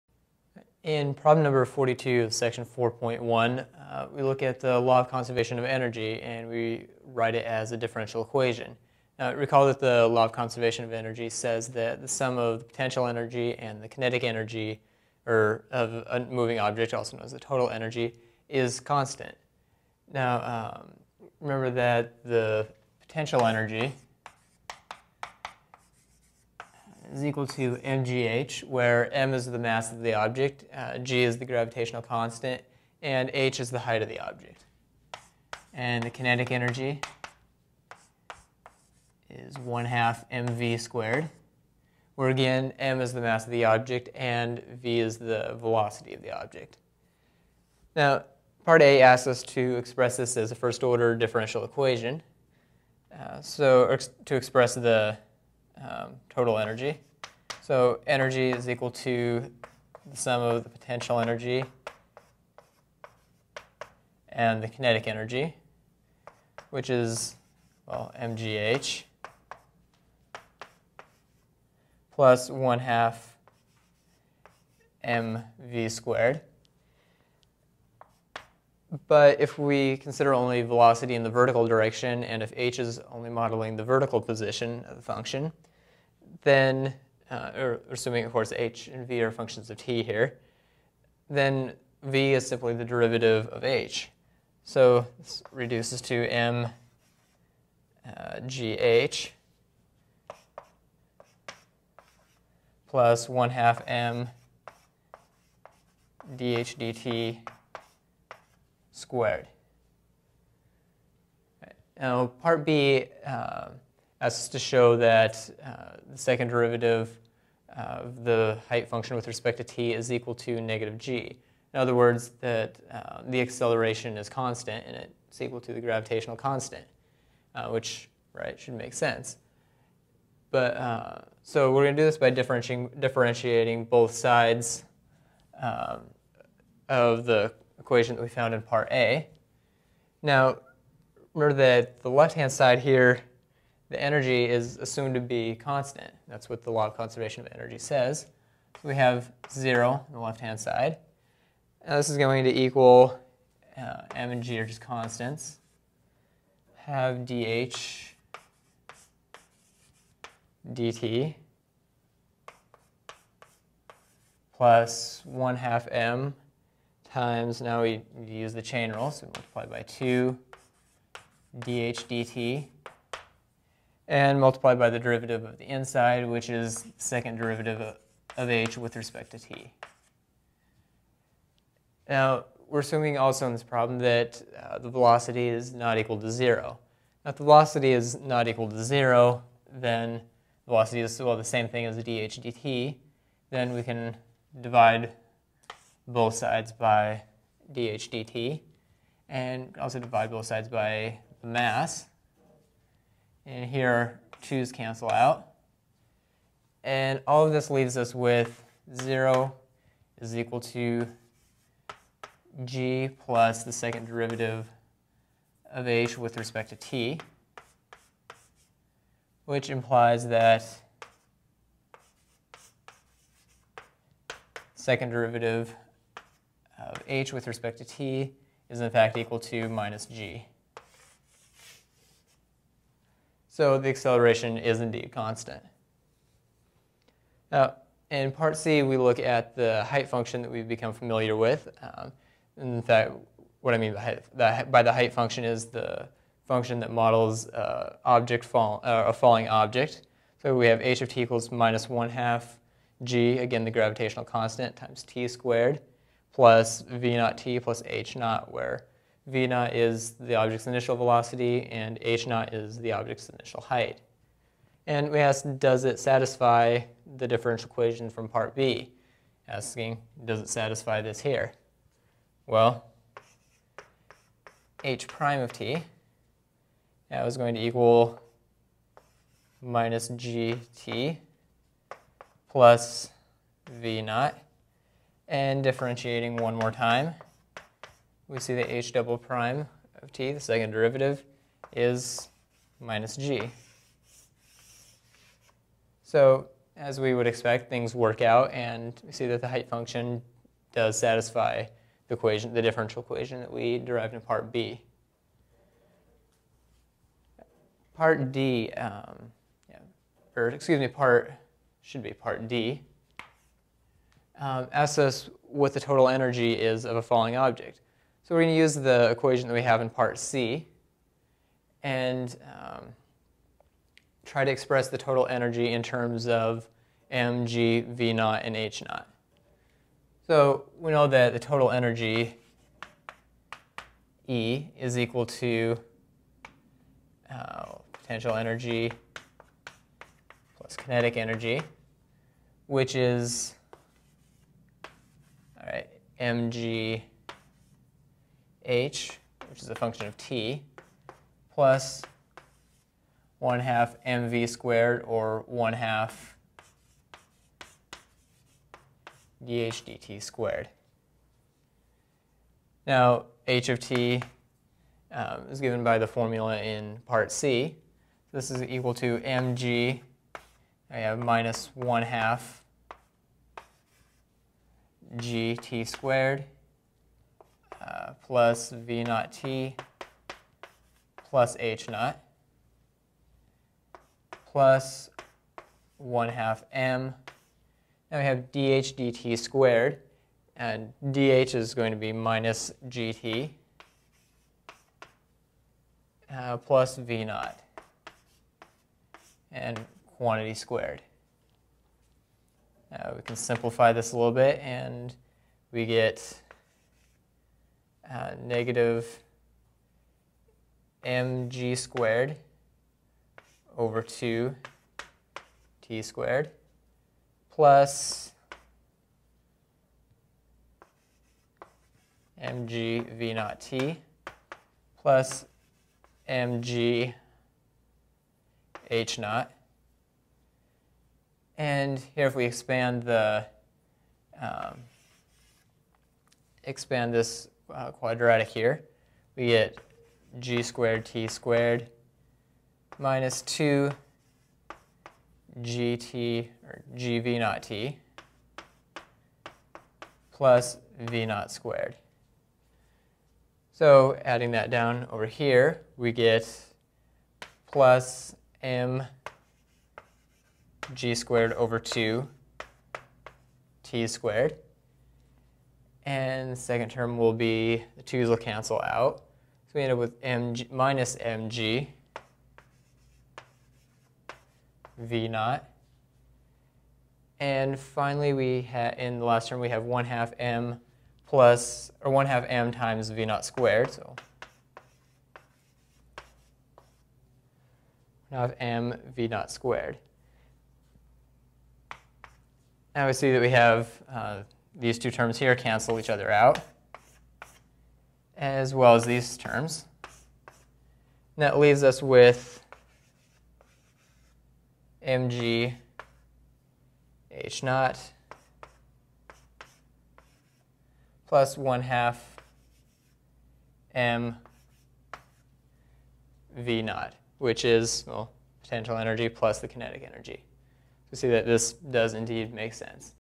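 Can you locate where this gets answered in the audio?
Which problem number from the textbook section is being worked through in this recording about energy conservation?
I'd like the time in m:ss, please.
0:01.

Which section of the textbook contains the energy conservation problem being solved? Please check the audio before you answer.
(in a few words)
4.1.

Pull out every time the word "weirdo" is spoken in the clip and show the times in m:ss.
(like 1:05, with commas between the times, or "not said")
not said.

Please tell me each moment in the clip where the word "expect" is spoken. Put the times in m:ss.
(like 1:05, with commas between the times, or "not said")
4:57.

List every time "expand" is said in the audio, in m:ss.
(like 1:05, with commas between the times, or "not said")
7:12, 7:16.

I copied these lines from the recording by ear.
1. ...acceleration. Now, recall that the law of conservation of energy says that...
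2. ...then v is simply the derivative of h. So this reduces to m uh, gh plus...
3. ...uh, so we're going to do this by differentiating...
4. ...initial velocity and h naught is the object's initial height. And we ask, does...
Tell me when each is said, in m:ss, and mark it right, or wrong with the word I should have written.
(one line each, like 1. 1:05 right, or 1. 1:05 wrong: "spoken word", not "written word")
1. 0:08 wrong: "equation", not "acceleration"
2. 1:31 right
3. 2:10 right
4. 4:20 right.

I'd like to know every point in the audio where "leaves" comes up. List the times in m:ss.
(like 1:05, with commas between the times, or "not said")
3:27, 8:21.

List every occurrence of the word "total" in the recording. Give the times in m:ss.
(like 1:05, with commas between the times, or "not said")
0:17, 0:56, 5:15, 5:24, 5:31.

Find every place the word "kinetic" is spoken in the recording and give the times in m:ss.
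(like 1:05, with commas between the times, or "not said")
0:13, 0:36, 1:04, 5:40, 8:39.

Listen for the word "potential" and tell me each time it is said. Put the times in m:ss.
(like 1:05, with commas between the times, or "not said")
0:12, 0:23, 1:00, 5:37, 8:38.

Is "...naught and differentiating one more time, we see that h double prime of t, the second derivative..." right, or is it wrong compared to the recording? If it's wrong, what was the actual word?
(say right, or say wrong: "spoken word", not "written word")
right.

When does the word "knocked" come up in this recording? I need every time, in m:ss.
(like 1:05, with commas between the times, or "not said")
not said.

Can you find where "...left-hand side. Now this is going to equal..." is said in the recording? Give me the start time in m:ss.
2:30.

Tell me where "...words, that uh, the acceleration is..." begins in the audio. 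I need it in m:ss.
2:01.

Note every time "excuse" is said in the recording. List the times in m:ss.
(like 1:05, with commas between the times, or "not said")
5:10.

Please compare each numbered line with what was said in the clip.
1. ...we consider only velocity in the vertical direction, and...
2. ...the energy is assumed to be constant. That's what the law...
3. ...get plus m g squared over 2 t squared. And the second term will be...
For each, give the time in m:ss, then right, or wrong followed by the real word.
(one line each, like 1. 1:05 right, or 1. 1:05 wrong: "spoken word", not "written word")
1. 1:19 right
2. 2:23 right
3. 7:36 right.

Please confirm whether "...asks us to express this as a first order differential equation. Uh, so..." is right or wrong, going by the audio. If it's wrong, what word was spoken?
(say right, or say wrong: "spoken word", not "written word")
right.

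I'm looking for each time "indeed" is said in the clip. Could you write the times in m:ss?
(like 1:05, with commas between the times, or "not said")
3:54, 8:42.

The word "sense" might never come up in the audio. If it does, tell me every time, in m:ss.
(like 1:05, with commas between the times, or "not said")
2:08, 8:42.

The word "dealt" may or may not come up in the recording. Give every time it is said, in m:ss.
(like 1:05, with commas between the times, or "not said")
not said.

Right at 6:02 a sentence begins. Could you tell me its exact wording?
Now, h of t um, is given by the formula in part C.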